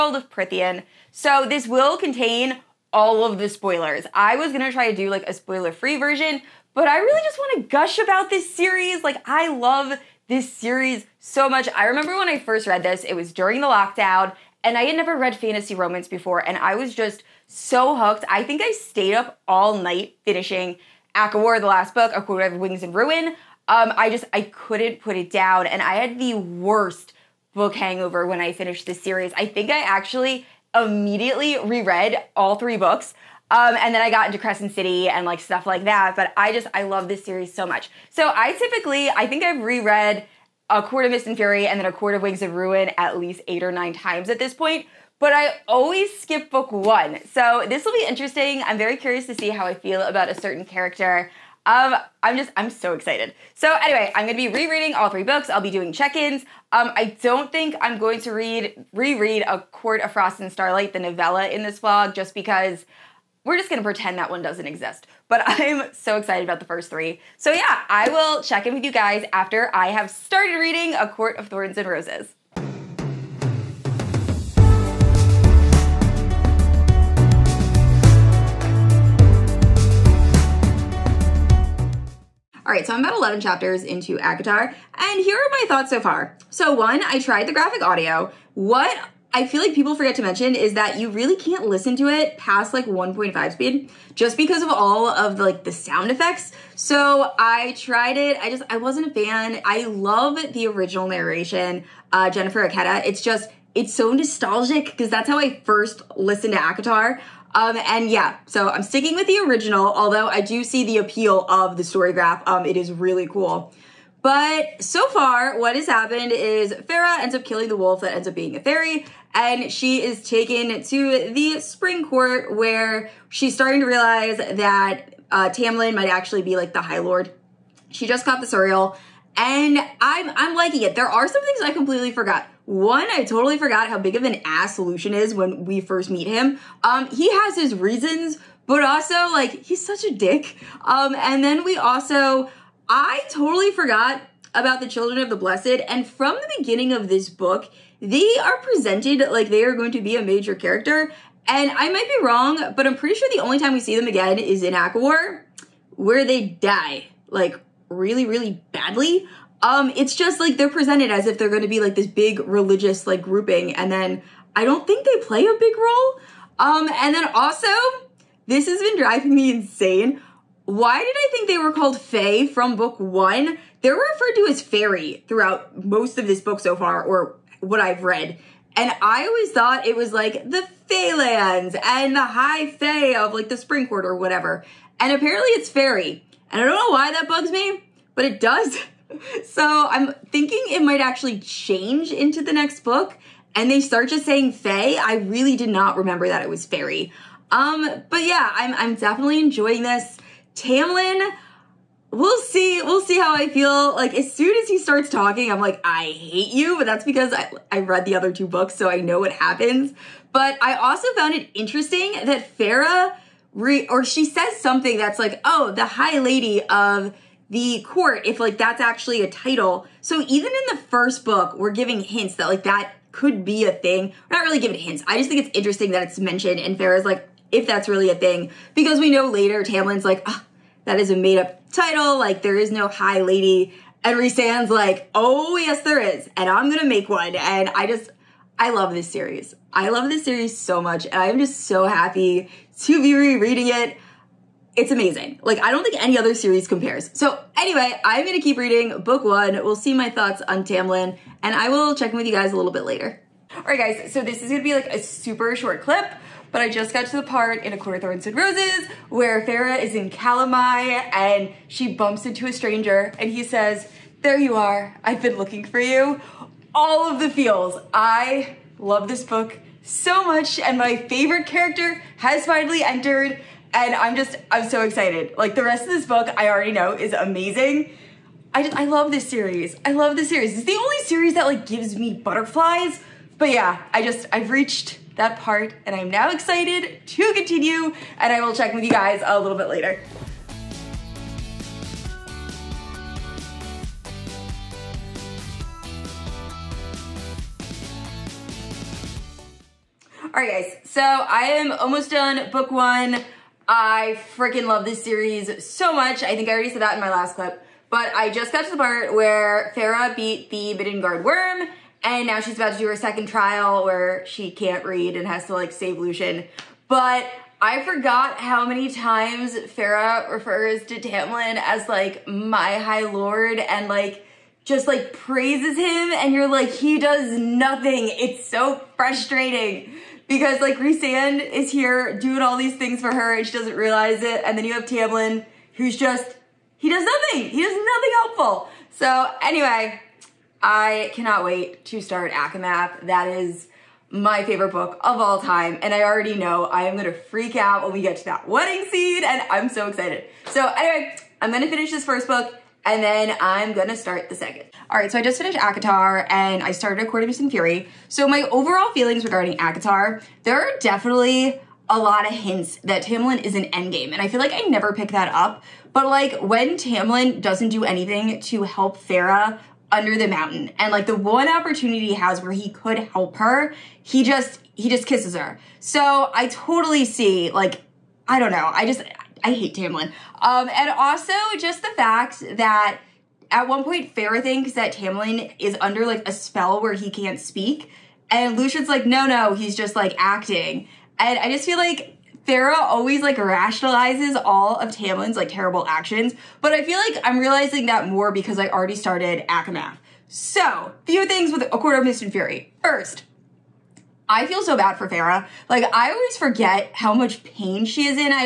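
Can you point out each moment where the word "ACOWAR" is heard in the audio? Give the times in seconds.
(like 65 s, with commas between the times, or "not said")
21 s, 154 s.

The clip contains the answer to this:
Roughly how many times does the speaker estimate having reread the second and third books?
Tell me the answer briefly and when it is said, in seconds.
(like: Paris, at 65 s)
8 or 9, at 43 s.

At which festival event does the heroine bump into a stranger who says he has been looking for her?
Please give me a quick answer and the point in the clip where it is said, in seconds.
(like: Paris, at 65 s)
Calanmai, at 260 s.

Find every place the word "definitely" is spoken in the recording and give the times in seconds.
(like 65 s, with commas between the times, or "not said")
198 s, 360 s.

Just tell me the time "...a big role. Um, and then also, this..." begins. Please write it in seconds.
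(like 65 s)
165 s.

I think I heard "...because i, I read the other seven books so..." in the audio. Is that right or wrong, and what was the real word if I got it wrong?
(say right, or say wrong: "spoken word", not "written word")
wrong: "two", not "seven".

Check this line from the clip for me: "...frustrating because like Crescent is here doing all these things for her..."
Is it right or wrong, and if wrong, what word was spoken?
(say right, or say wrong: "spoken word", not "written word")
wrong: "Rhysand", not "Crescent".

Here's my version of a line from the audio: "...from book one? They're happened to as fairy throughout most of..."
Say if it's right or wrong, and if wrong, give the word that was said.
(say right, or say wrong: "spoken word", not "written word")
wrong: "referred", not "happened".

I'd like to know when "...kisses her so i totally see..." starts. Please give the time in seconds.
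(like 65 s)
375 s.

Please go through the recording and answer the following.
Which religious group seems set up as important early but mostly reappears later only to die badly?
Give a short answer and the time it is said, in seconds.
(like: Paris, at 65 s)
Children of the Blessed, at 144 s.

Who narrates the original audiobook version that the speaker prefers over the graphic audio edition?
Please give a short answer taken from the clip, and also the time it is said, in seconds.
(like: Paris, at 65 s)
Jennifer Ikeda, at 102 s.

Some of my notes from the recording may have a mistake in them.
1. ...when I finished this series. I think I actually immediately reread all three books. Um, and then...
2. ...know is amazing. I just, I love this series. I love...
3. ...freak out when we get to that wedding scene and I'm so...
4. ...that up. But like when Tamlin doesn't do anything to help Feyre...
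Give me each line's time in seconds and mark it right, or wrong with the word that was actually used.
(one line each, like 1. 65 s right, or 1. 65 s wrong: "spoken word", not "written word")
1. 28 s right
2. 276 s right
3. 347 s right
4. 365 s right.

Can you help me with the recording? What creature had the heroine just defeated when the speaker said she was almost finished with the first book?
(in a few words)
Middengard Wurm.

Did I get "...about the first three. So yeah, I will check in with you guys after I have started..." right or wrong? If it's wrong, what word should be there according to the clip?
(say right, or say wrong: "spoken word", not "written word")
right.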